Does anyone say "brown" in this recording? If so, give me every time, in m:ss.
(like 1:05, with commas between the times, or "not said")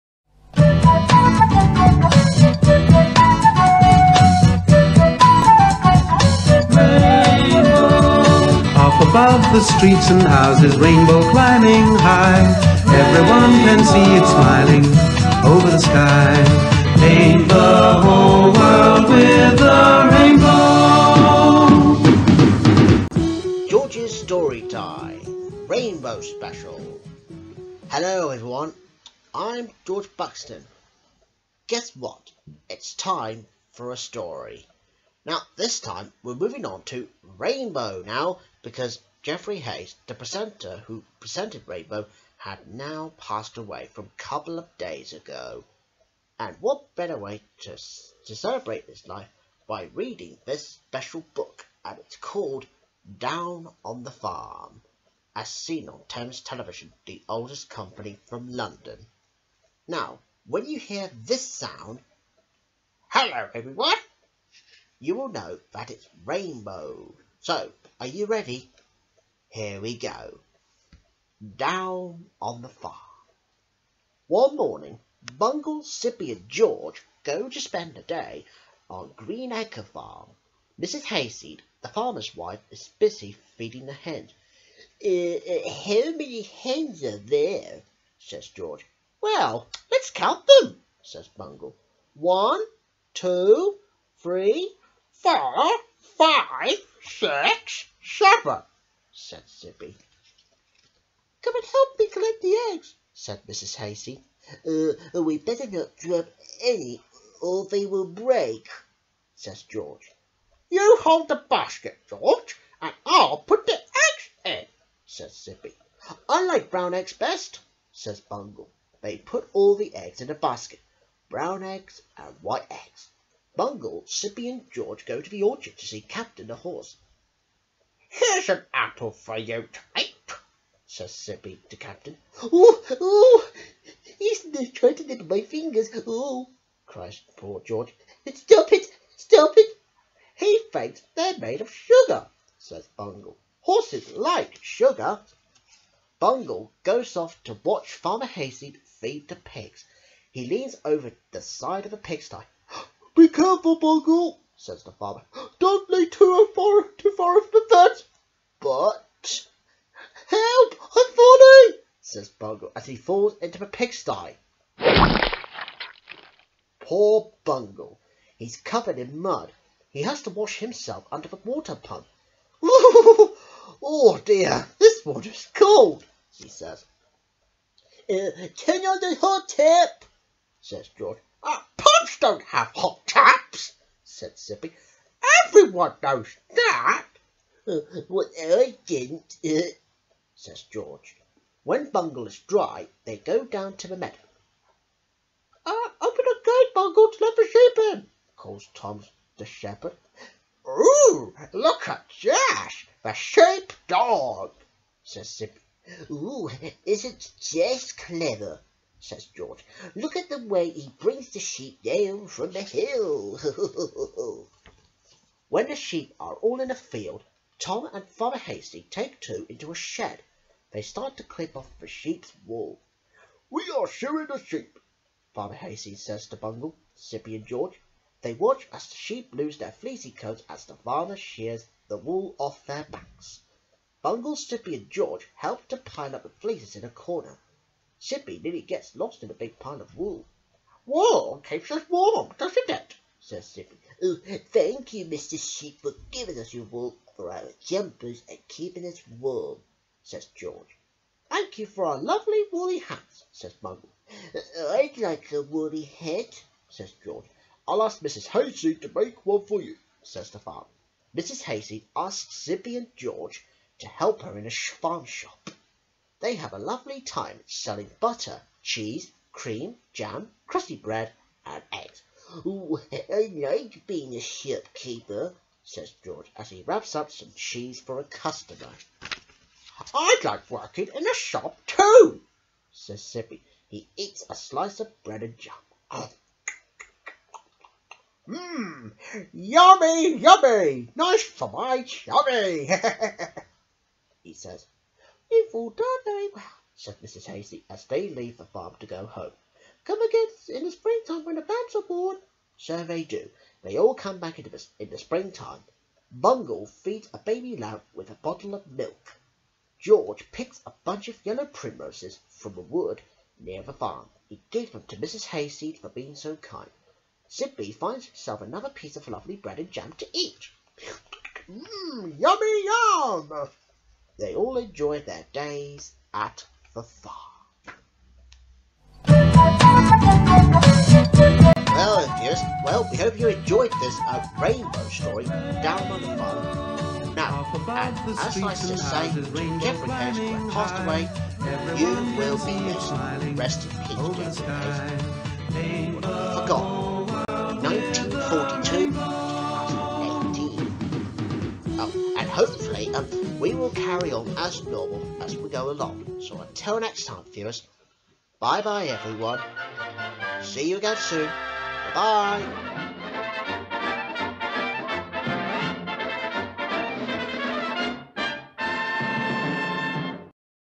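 1:56, 2:01.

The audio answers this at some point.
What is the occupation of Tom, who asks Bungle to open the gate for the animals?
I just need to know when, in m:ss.
3:19.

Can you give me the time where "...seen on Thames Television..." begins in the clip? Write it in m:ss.
0:55.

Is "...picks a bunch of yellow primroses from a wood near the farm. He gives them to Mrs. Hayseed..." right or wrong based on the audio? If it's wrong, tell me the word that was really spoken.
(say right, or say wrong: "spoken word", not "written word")
right.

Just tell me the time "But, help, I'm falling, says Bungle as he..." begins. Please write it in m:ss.
2:38.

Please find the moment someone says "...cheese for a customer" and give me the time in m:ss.
4:37.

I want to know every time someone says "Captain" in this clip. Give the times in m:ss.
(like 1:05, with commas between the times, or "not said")
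2:06, 2:11.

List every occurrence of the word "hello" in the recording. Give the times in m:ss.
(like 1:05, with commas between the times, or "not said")
0:27, 1:03.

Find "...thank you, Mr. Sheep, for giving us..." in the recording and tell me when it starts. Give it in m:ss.
4:04.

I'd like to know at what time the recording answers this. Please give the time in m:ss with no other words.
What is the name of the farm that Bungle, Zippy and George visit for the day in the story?
1:19.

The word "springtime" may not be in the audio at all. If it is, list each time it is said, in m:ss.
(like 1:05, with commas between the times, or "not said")
5:00, 5:04.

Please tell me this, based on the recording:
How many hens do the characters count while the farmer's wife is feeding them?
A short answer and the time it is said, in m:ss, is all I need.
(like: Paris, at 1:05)
7, at 1:38.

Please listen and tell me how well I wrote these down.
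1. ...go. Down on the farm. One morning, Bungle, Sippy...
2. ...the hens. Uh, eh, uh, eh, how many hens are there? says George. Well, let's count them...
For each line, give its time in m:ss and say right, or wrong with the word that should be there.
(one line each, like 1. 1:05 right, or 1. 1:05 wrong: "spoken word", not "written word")
1. 1:09 right
2. 1:23 right.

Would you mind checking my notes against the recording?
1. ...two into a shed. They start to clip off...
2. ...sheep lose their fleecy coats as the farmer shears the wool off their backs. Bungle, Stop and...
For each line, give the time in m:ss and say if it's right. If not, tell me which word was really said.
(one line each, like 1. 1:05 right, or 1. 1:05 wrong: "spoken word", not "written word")
1. 3:39 right
2. 3:48 wrong: "Sippy", not "Stop".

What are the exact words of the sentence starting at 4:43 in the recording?
He eats a slice of bread and jam.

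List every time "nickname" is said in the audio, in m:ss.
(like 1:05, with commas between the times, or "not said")
not said.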